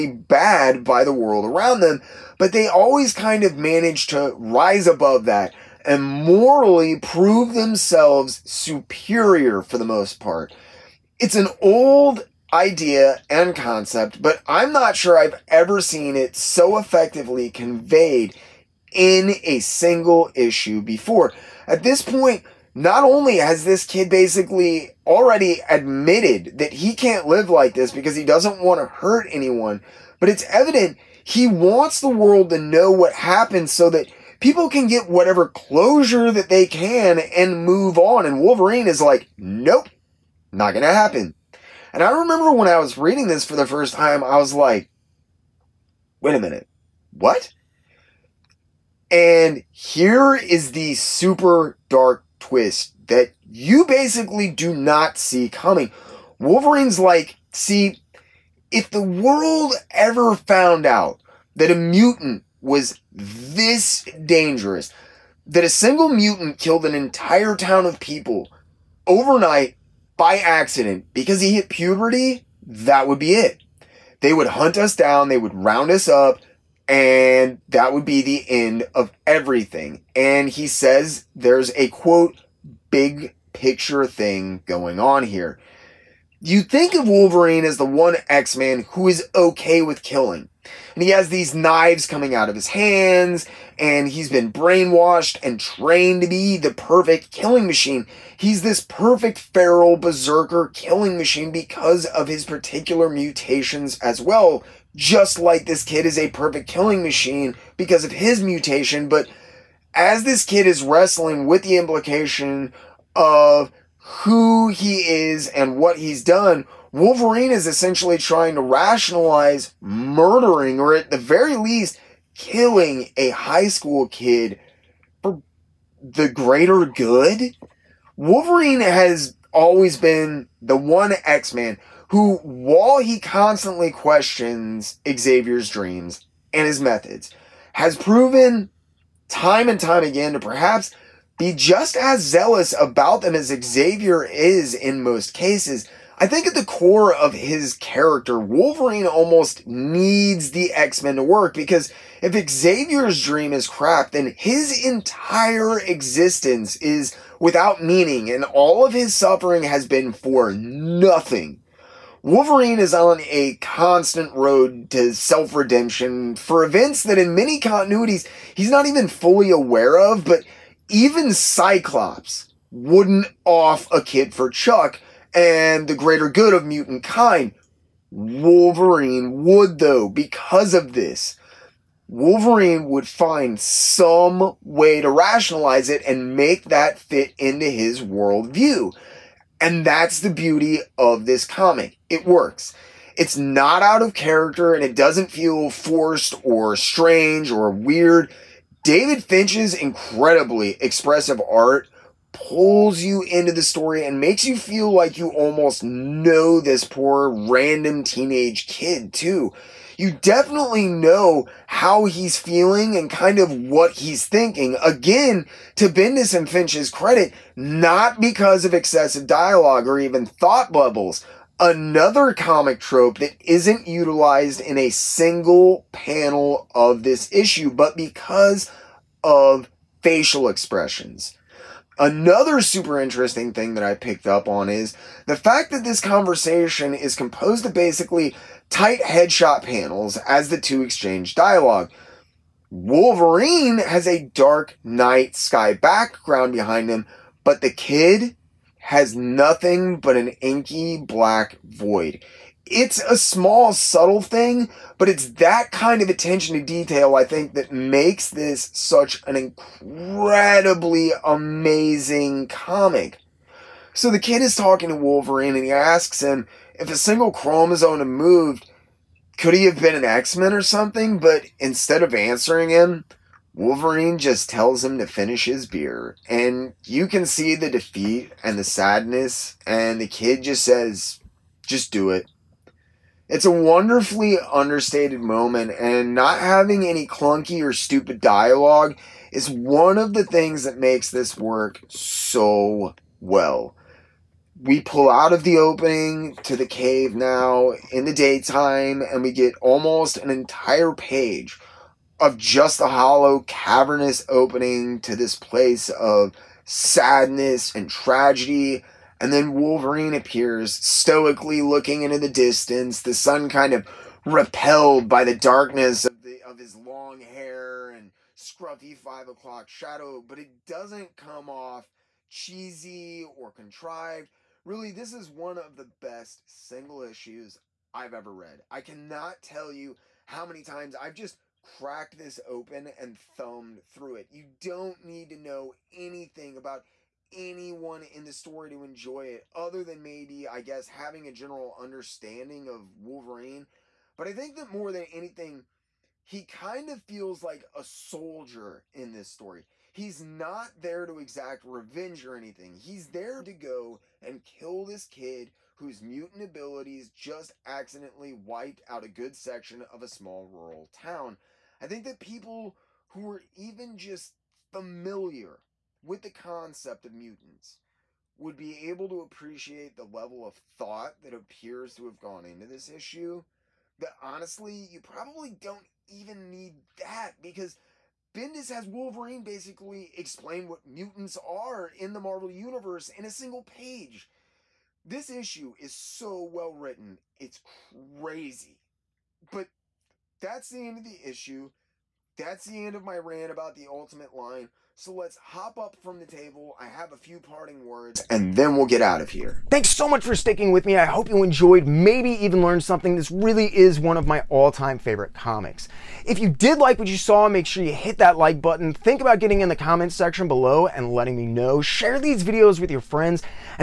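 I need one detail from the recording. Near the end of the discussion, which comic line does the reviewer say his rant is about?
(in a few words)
the Ultimate line.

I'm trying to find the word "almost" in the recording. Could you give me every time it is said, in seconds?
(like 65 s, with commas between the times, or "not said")
149 s, 205 s, 299 s.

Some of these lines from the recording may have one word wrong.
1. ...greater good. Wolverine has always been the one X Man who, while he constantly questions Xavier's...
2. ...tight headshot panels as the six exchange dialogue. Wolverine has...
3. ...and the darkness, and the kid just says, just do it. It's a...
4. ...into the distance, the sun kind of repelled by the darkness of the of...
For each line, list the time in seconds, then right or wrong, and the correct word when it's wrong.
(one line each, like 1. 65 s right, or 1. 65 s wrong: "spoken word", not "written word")
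1. 126 s right
2. 238 s wrong: "two", not "six"
3. 278 s wrong: "sadness", not "darkness"
4. 312 s right.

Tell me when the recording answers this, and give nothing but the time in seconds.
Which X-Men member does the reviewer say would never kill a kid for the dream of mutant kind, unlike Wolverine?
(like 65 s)
171 s.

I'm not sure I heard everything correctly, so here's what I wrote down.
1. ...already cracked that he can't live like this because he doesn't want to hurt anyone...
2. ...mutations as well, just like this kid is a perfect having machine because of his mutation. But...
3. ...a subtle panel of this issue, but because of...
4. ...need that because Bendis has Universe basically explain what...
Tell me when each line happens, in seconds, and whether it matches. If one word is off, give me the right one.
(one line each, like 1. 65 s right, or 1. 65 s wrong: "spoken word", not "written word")
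1. 25 s wrong: "admitted", not "cracked"
2. 103 s wrong: "killing", not "having"
3. 224 s wrong: "single", not "subtle"
4. 376 s wrong: "Wolverine", not "Universe".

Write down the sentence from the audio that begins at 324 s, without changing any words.
Really, this is one of the best single issues I've ever read.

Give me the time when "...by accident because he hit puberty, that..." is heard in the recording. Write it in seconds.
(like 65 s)
70 s.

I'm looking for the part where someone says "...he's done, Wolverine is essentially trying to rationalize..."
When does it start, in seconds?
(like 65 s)
115 s.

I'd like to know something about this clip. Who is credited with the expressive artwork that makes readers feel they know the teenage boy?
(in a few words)
David Finch.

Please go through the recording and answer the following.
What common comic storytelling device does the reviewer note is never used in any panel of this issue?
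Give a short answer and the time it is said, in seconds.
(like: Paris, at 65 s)
thought bubbles, at 220 s.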